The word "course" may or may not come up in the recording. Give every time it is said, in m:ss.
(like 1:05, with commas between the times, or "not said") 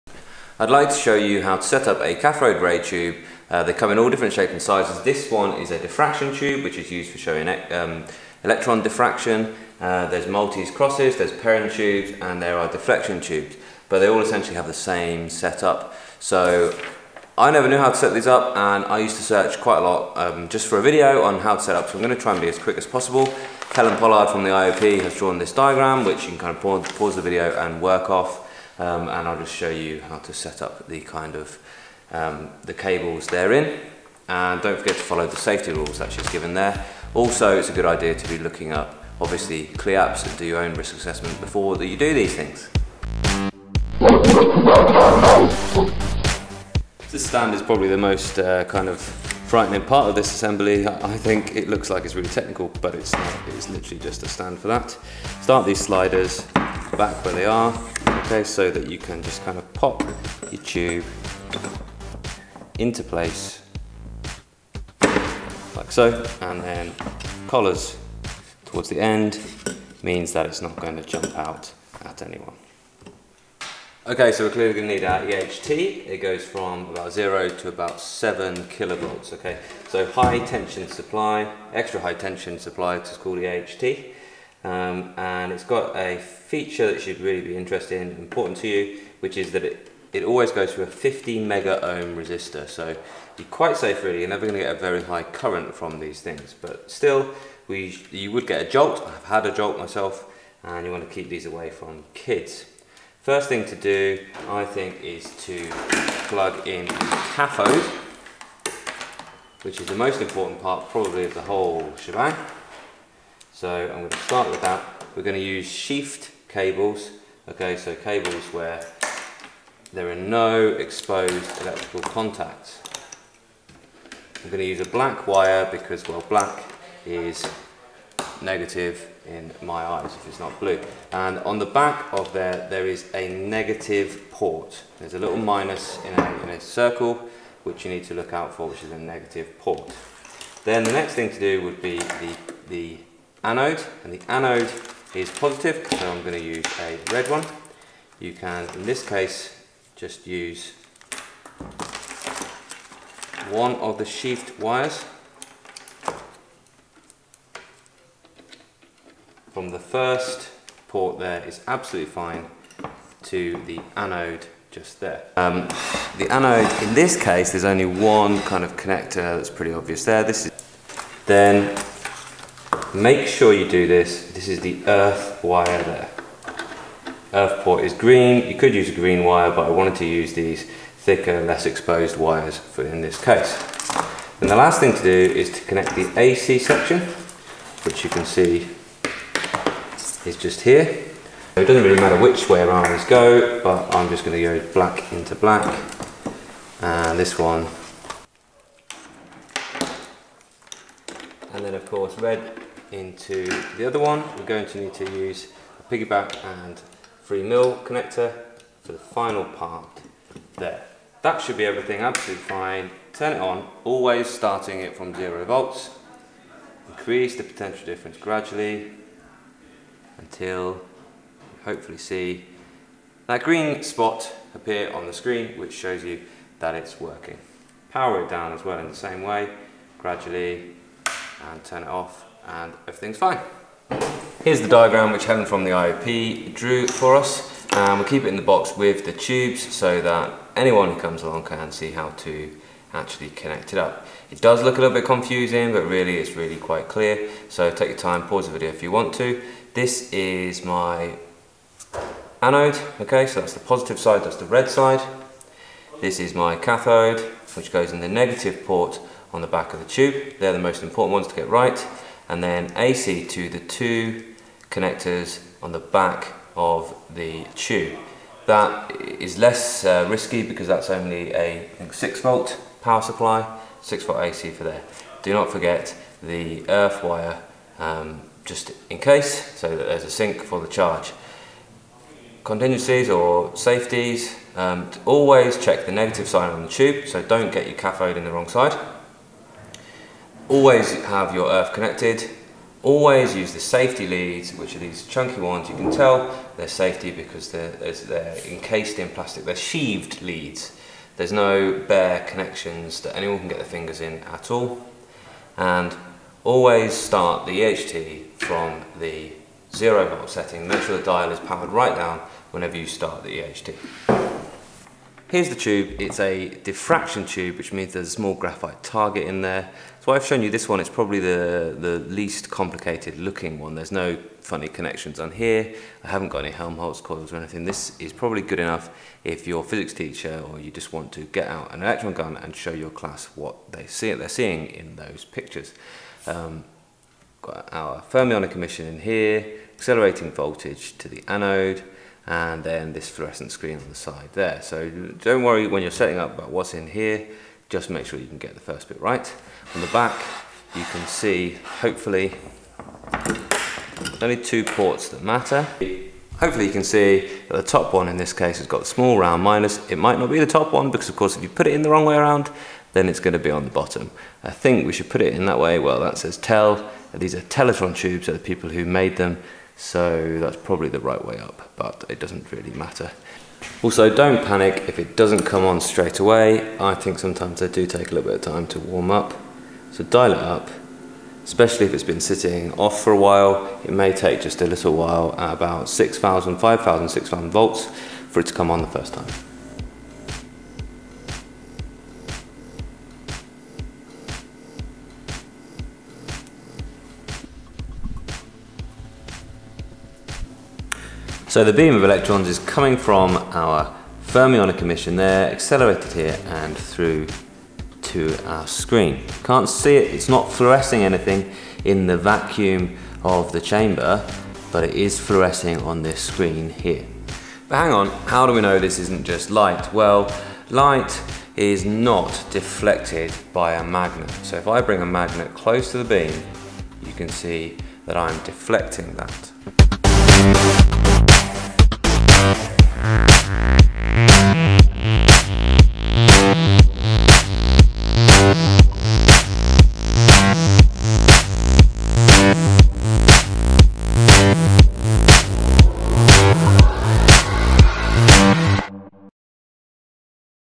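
3:21, 6:01.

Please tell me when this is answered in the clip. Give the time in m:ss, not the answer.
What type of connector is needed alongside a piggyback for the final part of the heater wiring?
3:27.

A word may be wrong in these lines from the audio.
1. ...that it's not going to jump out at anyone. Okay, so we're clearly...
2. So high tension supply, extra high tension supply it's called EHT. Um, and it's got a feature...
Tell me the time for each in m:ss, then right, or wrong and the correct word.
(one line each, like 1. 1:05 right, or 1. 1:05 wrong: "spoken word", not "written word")
1. 1:10 right
2. 1:19 right.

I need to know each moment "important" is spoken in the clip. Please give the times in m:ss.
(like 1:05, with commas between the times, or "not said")
1:28, 1:50, 4:20.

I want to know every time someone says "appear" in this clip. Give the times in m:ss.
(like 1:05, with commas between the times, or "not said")
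3:44.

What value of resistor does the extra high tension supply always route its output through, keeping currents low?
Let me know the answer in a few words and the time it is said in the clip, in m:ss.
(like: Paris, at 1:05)
15 megaohm, at 1:30.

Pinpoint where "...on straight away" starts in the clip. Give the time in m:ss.
6:15.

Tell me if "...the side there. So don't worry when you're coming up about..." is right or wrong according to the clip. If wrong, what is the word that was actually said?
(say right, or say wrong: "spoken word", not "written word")
wrong: "setting", not "coming".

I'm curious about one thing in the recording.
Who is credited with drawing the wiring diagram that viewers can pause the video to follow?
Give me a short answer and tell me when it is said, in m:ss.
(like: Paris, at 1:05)
Helen Pollard, at 0:23.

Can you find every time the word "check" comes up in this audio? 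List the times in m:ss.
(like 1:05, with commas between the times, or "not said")
4:45.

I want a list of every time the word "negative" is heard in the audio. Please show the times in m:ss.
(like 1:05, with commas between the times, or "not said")
2:08, 2:13, 2:18, 4:18, 4:45.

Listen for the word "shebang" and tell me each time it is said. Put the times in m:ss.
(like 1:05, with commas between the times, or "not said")
1:51.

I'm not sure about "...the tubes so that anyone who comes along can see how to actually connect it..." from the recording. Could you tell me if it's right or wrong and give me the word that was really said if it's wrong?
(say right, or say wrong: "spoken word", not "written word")
right.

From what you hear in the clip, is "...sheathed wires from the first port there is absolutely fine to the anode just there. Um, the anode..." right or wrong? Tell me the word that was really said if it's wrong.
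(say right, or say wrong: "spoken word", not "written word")
right.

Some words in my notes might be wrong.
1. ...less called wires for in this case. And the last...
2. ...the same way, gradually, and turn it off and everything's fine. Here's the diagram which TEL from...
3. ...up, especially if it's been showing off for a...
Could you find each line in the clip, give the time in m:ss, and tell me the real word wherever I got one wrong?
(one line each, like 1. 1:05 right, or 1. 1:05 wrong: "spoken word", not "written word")
1. 3:01 wrong: "exposed", not "called"
2. 3:48 wrong: "Helen", not "TEL"
3. 6:20 wrong: "sitting", not "showing".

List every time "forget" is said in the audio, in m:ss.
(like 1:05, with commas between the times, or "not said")
0:34, 4:35.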